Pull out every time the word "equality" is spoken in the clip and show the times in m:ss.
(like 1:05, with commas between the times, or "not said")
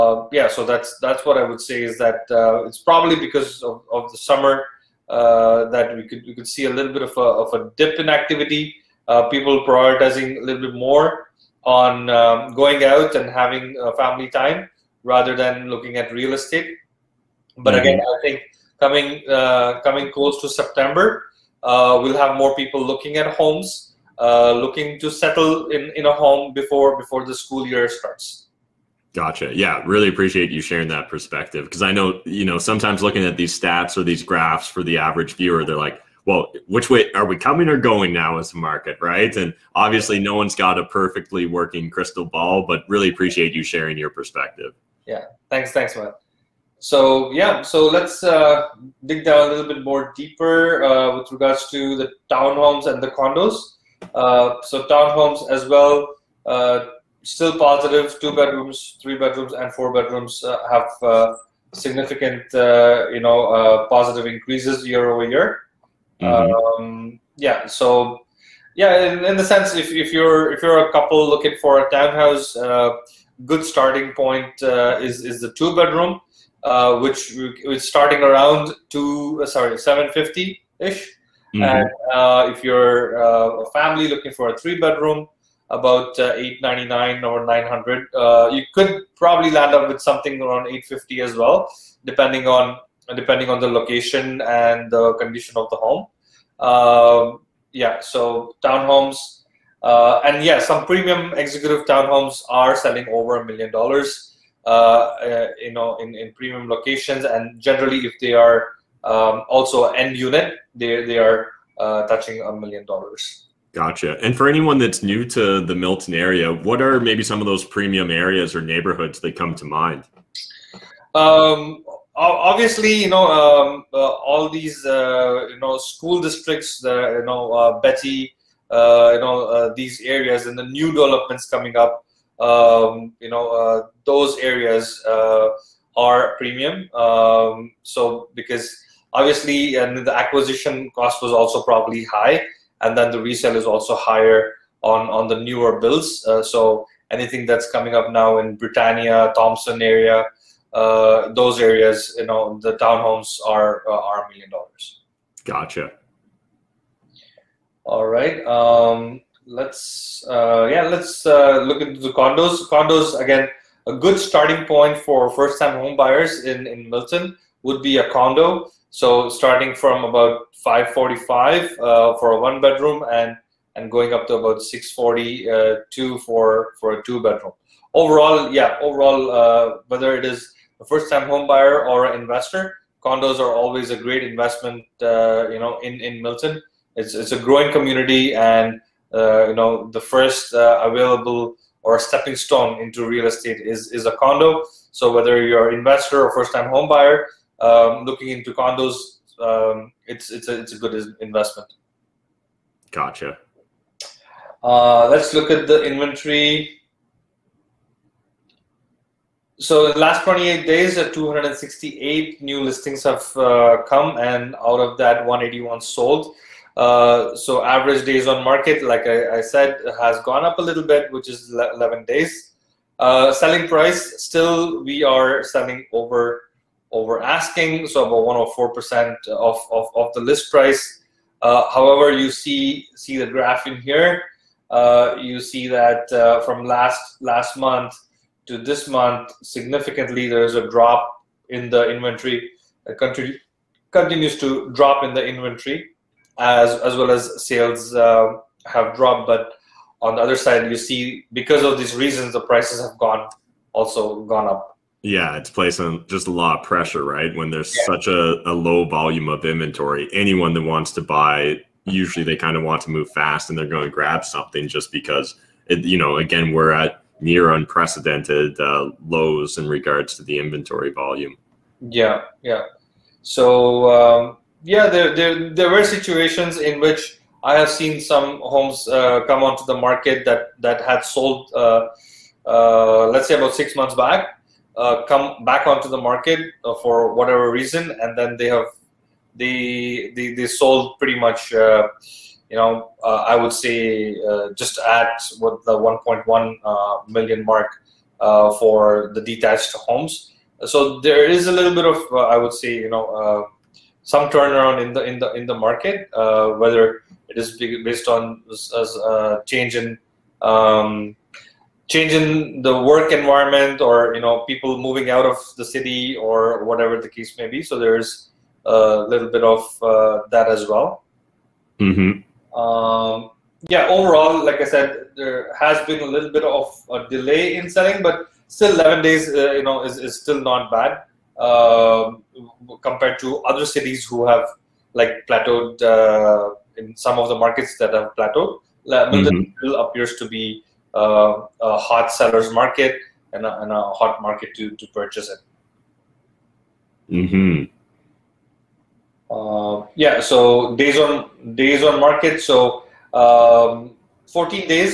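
not said.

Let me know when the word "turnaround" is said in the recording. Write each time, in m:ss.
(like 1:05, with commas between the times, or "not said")
5:04.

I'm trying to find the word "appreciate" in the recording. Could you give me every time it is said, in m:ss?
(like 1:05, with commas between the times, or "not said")
0:30, 0:43.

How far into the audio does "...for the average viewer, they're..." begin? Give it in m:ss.
0:34.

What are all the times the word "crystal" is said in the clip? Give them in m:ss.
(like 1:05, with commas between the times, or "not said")
0:41.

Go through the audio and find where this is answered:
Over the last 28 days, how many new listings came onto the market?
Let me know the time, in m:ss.
3:31.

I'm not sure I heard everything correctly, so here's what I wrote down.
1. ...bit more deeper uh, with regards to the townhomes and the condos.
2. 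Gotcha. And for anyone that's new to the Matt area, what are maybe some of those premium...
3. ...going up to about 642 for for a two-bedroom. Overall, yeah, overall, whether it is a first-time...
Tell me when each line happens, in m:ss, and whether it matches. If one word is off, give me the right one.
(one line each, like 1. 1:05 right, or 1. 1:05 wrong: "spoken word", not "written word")
1. 0:49 right
2. 1:53 wrong: "Milton", not "Matt"
3. 2:53 right.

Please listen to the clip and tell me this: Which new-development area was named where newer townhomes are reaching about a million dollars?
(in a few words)
Britannia Thompson.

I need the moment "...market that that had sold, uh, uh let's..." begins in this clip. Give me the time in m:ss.
4:39.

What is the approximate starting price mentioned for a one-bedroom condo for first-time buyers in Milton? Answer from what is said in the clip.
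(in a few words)
545.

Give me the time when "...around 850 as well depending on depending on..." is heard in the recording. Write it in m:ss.
1:30.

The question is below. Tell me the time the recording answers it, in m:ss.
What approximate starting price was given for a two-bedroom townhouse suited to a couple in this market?
1:19.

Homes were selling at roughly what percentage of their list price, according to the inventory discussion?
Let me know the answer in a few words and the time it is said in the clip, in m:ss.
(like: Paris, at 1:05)
104%, at 3:48.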